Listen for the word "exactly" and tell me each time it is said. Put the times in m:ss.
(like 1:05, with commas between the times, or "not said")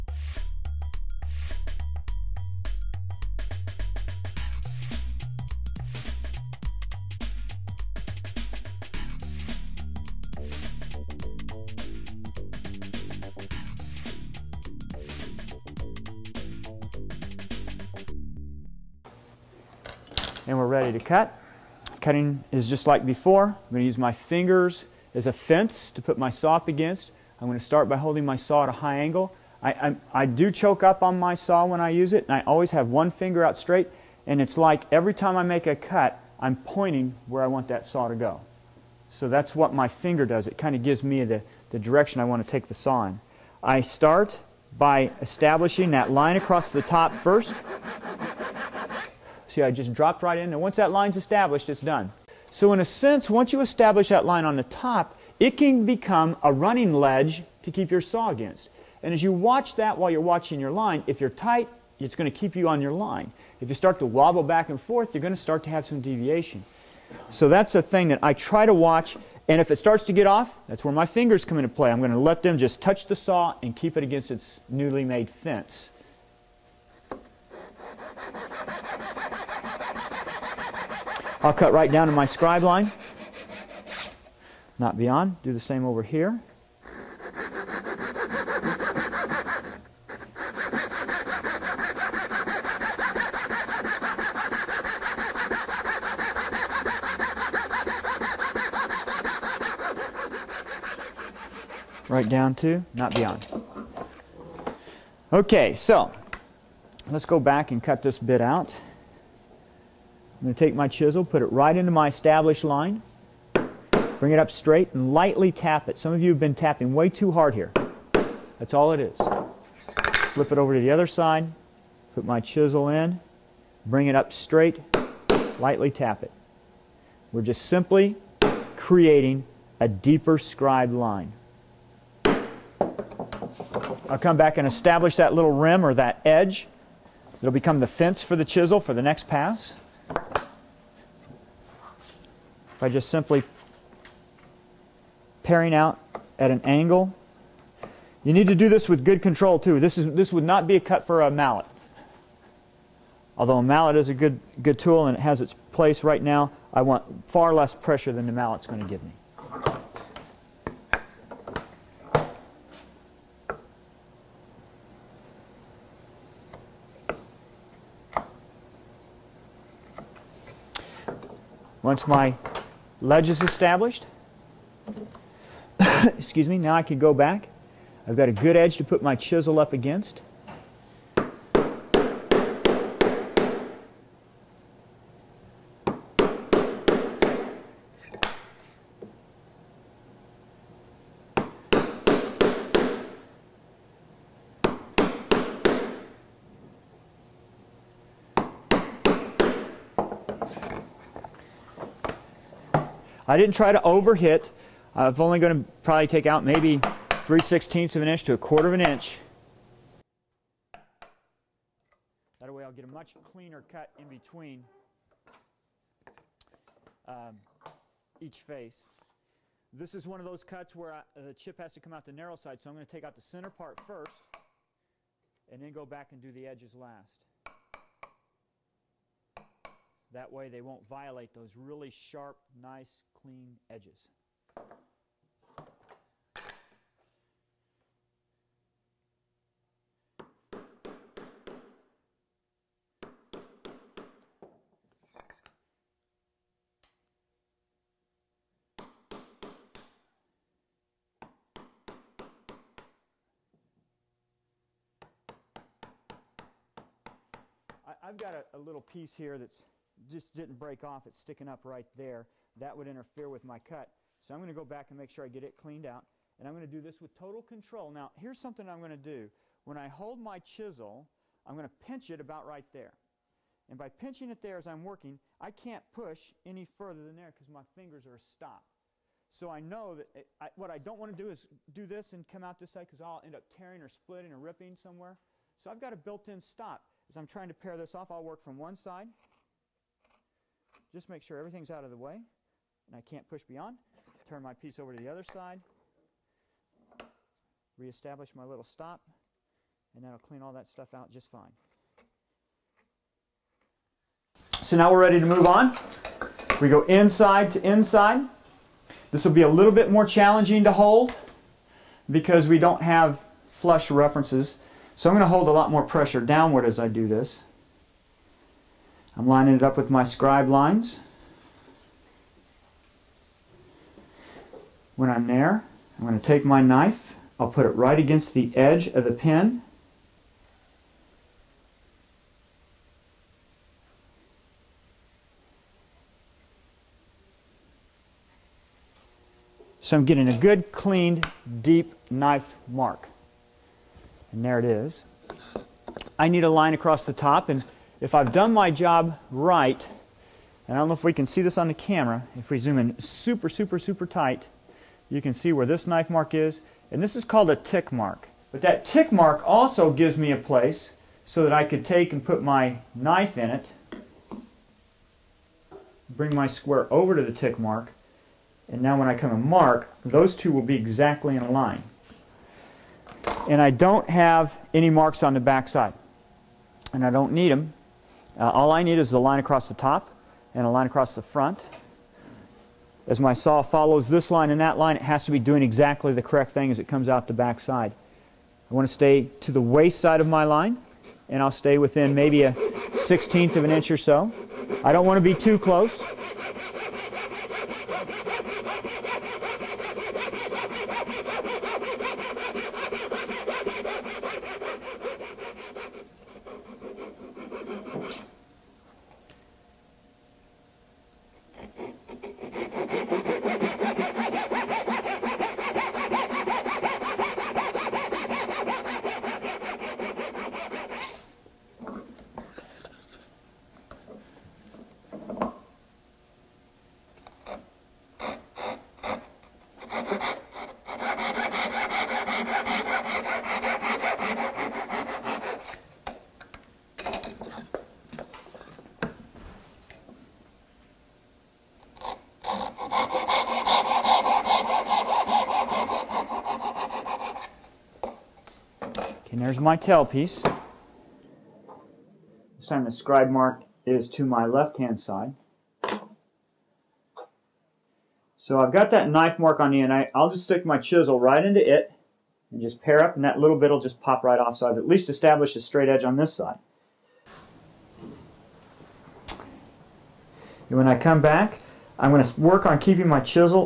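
6:10, 6:25.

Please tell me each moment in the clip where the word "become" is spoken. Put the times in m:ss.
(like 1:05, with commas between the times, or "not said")
0:55, 2:17.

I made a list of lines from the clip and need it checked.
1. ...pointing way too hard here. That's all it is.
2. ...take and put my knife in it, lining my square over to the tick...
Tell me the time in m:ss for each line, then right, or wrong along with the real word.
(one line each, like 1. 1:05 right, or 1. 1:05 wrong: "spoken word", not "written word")
1. 1:56 wrong: "tapping", not "pointing"
2. 6:01 wrong: "bring", not "lining".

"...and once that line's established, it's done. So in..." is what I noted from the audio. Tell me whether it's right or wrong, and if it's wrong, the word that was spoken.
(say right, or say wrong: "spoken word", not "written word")
right.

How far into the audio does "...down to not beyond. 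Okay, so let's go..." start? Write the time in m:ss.
1:42.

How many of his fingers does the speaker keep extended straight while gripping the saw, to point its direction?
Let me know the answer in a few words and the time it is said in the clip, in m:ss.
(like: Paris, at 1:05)
1, at 0:32.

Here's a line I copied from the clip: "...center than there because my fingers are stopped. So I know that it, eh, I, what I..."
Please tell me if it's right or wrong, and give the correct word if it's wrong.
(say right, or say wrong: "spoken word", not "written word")
wrong: "further", not "center".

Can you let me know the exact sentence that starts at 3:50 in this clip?
That way they won't violate those really sharp, nice, clean edges.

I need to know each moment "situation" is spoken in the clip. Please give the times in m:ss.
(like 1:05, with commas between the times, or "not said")
not said.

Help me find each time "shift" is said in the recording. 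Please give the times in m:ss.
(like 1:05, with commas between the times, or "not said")
not said.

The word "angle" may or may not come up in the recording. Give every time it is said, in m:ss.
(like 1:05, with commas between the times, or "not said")
0:28, 2:26.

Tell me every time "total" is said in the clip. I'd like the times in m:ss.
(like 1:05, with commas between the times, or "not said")
4:27.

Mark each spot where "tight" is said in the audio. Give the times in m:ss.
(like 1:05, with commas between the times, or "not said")
1:01, 5:54.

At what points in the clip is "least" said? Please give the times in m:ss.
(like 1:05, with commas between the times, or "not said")
7:44.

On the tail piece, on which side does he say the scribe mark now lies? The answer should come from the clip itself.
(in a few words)
left-hand side.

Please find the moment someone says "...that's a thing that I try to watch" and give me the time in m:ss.
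1:07.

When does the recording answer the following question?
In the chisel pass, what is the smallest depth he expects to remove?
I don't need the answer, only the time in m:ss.
3:27.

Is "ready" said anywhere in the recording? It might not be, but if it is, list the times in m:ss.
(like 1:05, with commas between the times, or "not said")
0:20, 5:05.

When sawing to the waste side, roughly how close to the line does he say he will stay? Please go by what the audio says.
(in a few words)
1/16 inch.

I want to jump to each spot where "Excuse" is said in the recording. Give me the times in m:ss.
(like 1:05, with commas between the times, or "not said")
2:56.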